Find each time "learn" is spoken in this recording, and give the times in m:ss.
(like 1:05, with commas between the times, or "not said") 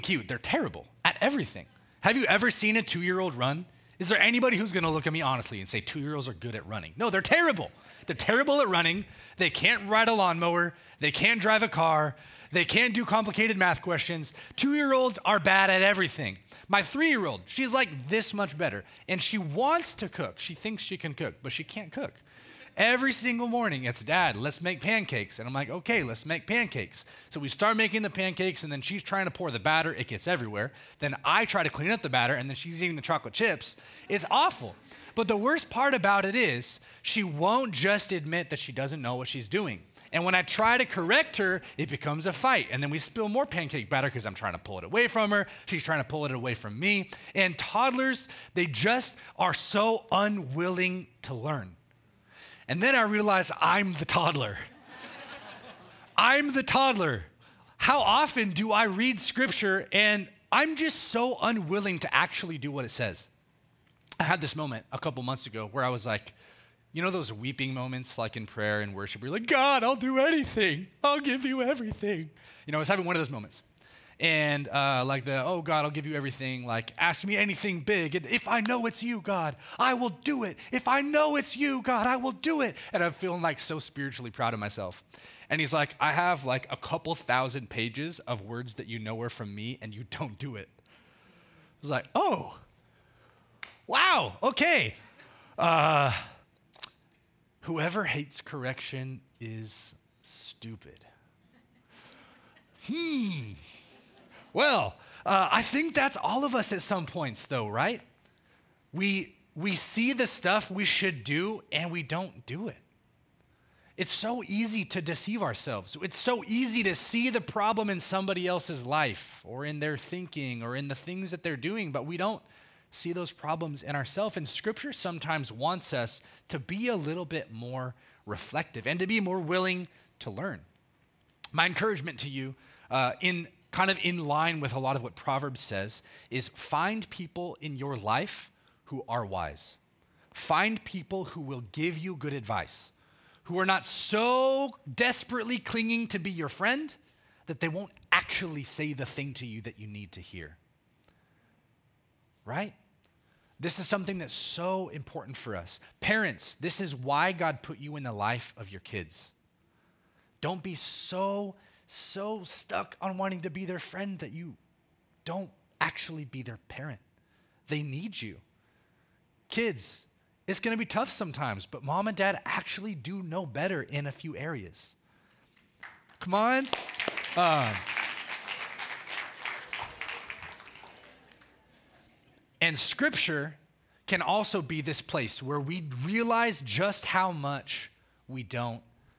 0:51, 2:10.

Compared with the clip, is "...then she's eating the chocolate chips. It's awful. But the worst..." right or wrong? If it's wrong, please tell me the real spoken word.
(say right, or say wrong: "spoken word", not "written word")
right.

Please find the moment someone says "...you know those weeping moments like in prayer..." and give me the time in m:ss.
1:06.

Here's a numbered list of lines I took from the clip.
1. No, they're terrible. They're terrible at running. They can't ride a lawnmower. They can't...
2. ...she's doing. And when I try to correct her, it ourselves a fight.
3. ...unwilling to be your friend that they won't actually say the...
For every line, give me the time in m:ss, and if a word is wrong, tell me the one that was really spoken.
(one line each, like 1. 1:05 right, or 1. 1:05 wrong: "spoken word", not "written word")
1. 0:06 right
2. 0:39 wrong: "becomes", not "ourselves"
3. 2:25 wrong: "clinging", not "unwilling".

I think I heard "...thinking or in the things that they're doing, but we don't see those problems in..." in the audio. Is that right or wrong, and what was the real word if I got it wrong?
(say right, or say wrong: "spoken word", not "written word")
right.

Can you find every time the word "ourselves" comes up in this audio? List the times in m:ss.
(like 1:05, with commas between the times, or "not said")
1:55, 2:03.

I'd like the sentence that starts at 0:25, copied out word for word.
And I'm like, okay, let's make pancakes.